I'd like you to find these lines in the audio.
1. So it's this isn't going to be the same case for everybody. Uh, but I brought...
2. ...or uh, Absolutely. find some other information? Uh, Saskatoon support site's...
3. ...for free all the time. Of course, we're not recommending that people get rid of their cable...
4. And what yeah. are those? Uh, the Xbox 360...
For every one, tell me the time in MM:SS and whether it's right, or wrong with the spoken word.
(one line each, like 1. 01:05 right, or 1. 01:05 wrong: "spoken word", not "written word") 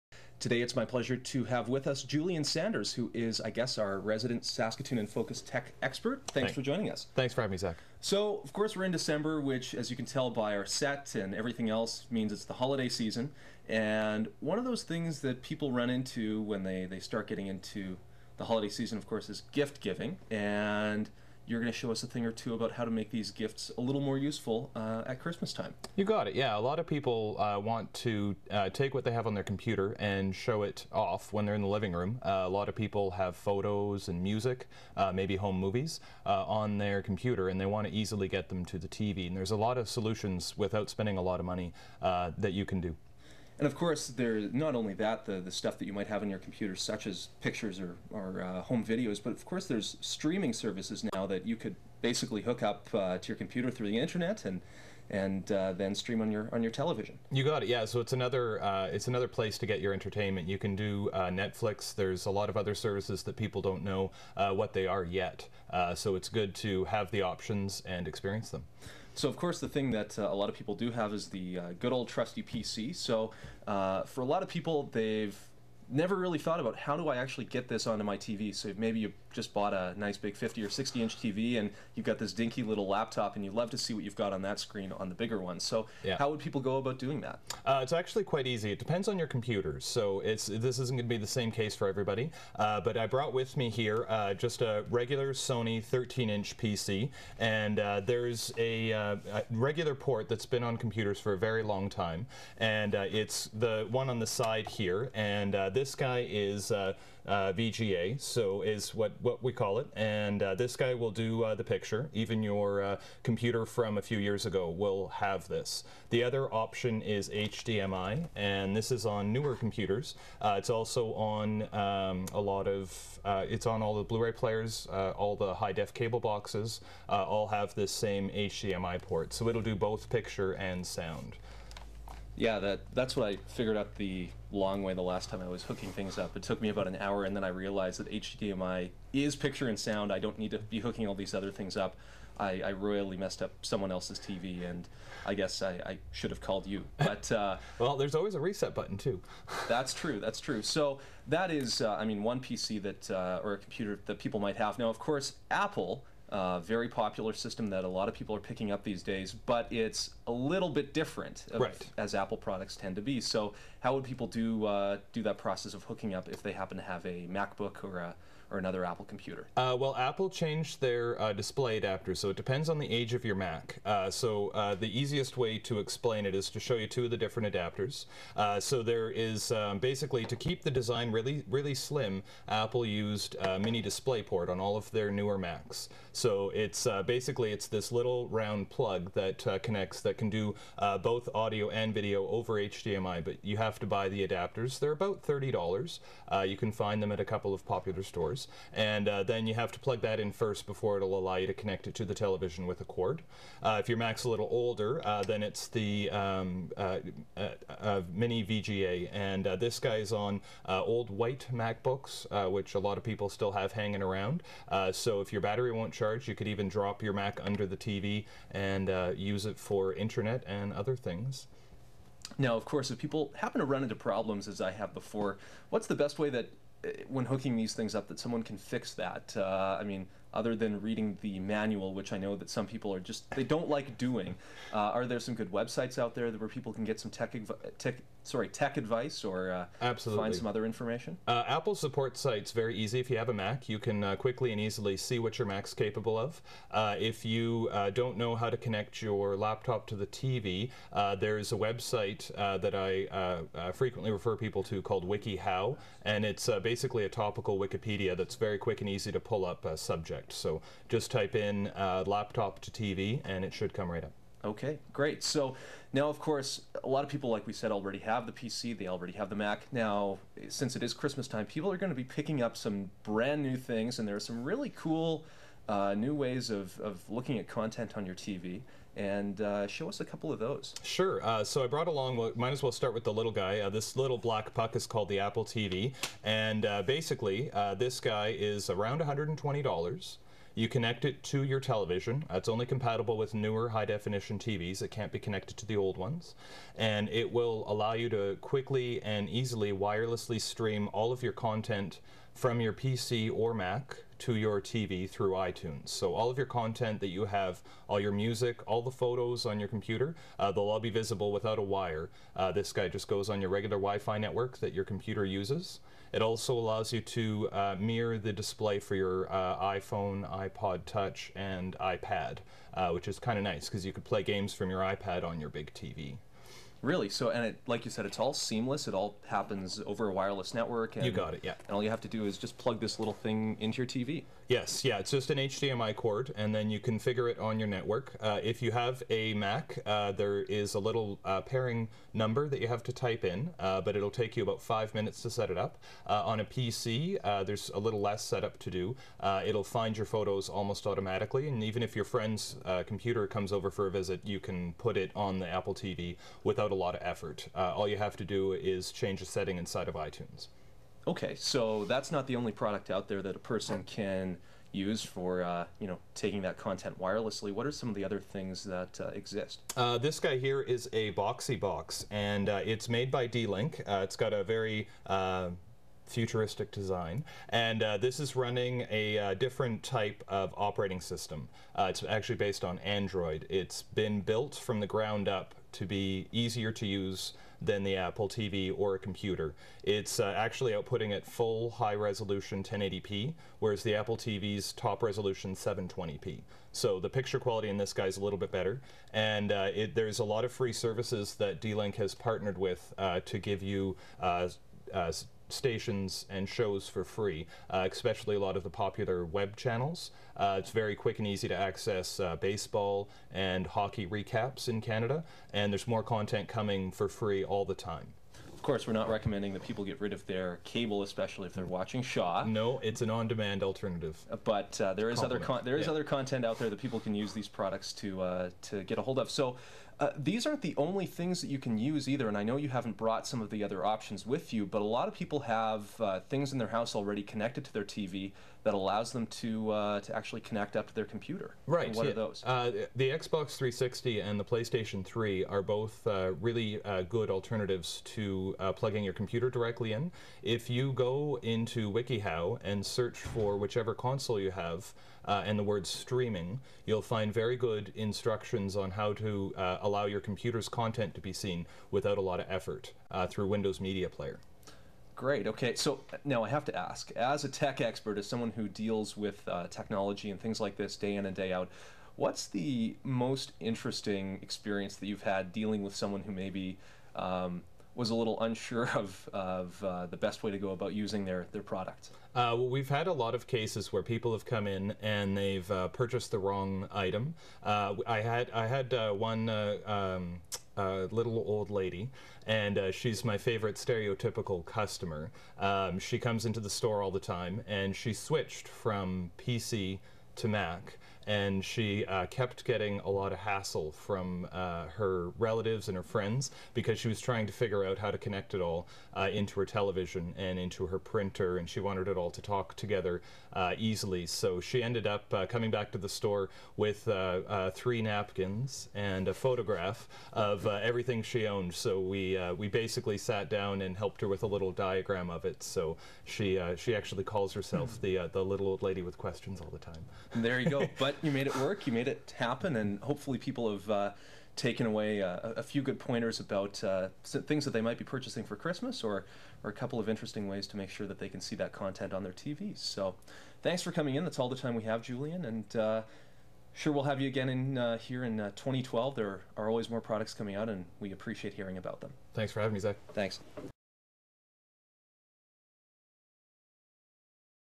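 1. 01:29 right
2. 03:59 wrong: "Apple", not "Saskatoon"
3. 06:56 right
4. 07:21 right.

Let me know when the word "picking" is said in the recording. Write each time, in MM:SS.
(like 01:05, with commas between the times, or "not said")
02:38, 04:32.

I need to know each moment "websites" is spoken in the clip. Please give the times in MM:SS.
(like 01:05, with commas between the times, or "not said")
03:55, 04:11.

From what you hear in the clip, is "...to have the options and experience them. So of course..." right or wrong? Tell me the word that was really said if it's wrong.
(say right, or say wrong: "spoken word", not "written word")
right.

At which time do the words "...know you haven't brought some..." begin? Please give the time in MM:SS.
07:12.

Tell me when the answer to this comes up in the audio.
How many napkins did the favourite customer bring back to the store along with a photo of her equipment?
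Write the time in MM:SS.
08:37.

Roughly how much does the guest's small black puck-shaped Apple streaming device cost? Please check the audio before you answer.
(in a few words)
$120.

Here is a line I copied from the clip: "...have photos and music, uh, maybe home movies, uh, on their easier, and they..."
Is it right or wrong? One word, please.
wrong.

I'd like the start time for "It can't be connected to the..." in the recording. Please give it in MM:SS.
04:54.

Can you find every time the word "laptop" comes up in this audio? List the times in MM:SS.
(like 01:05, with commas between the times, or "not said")
01:22, 04:09, 04:22.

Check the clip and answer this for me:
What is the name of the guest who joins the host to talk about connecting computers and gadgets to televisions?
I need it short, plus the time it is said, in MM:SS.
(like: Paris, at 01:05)
Julian Sanders, at 00:02.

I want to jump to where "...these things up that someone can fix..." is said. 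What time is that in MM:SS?
03:47.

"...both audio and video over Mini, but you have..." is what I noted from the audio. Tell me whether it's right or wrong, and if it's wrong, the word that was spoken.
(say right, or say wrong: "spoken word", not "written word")
wrong: "HDMI", not "Mini".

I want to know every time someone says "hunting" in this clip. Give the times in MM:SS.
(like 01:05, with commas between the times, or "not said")
not said.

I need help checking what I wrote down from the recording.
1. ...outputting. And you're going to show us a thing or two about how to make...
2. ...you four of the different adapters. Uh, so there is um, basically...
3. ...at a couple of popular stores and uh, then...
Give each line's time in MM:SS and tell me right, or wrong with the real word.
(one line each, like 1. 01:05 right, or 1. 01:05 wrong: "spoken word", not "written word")
1. 00:19 wrong: "giving", not "outputting"
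2. 02:56 wrong: "two", not "four"
3. 03:17 right.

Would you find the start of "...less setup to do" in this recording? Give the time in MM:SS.
05:48.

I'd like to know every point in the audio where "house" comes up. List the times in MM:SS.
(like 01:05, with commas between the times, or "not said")
07:16.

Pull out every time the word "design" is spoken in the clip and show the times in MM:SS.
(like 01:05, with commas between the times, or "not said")
03:00, 06:16.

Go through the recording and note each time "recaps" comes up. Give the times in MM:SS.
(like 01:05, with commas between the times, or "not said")
06:54.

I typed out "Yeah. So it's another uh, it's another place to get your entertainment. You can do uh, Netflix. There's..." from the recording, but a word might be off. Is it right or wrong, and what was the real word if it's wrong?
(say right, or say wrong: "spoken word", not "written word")
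right.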